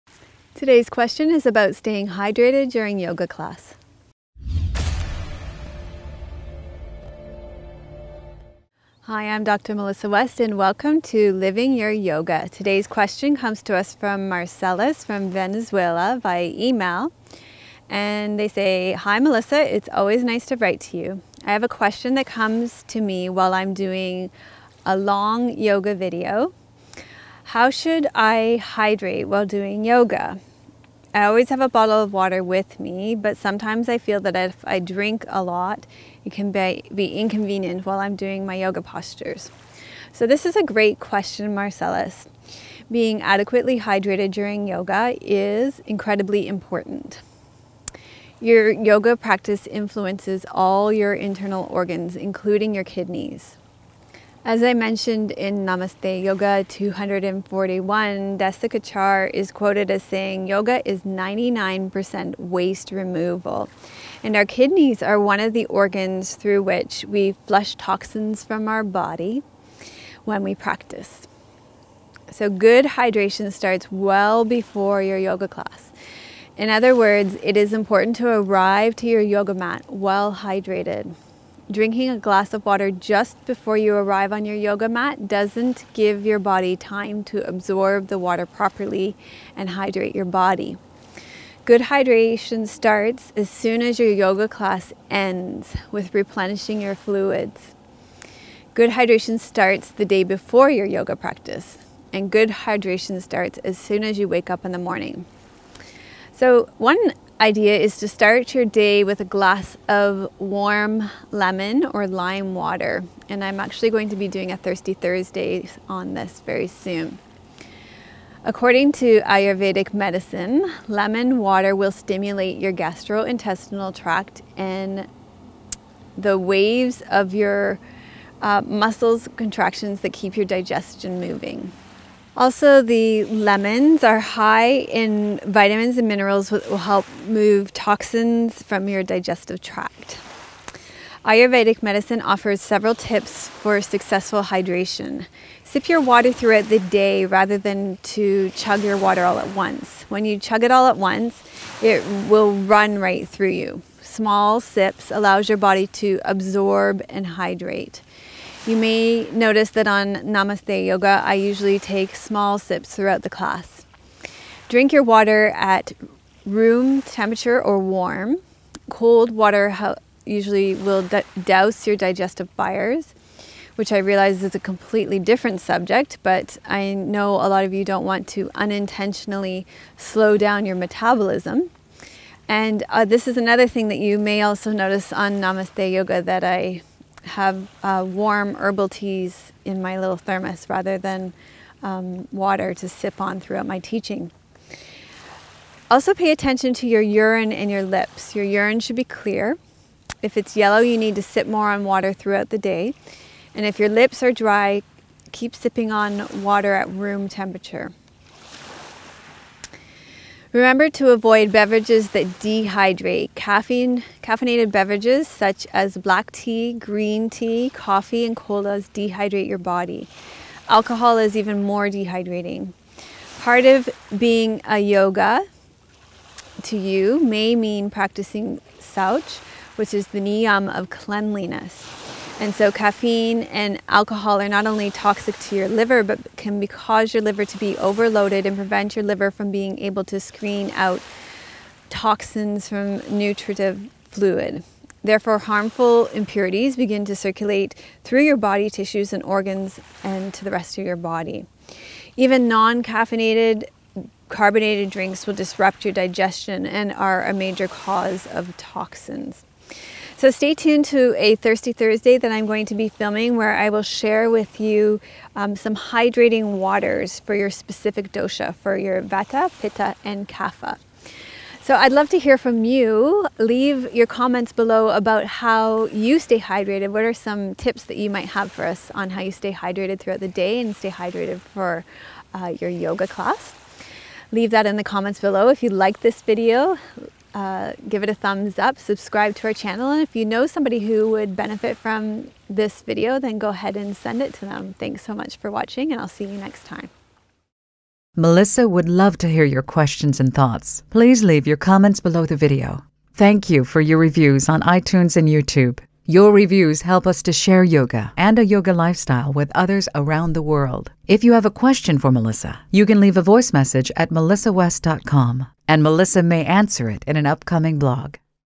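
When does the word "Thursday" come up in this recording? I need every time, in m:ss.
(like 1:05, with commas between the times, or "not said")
1:54, 4:21.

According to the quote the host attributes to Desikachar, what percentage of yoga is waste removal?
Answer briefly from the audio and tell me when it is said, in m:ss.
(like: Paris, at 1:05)
99%, at 1:01.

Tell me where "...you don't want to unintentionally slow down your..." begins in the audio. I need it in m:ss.
2:57.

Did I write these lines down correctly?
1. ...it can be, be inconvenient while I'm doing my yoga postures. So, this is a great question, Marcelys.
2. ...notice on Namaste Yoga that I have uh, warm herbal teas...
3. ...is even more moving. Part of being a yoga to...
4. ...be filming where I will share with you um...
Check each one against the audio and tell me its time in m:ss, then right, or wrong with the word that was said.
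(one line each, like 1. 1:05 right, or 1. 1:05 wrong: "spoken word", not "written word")
1. 0:36 right
2. 3:04 right
3. 3:41 wrong: "dehydrating", not "moving"
4. 4:22 right.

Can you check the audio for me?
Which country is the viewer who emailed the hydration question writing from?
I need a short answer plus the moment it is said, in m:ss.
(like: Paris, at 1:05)
Venezuela, at 0:15.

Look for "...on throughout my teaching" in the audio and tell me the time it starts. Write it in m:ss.
3:13.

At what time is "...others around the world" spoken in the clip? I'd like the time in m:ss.
5:09.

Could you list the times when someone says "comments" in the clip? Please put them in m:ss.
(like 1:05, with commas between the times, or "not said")
4:34, 4:44, 5:01.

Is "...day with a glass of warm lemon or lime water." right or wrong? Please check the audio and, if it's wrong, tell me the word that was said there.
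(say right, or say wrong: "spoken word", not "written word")
right.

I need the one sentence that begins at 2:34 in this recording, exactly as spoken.
Small sips allows your body to absorb and hydrate.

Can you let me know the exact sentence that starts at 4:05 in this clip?
Therefore, harmful impurities begin to circulate through your body tissues and organs and to the rest of your body.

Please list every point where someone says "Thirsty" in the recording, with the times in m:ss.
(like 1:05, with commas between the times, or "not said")
1:54, 4:21.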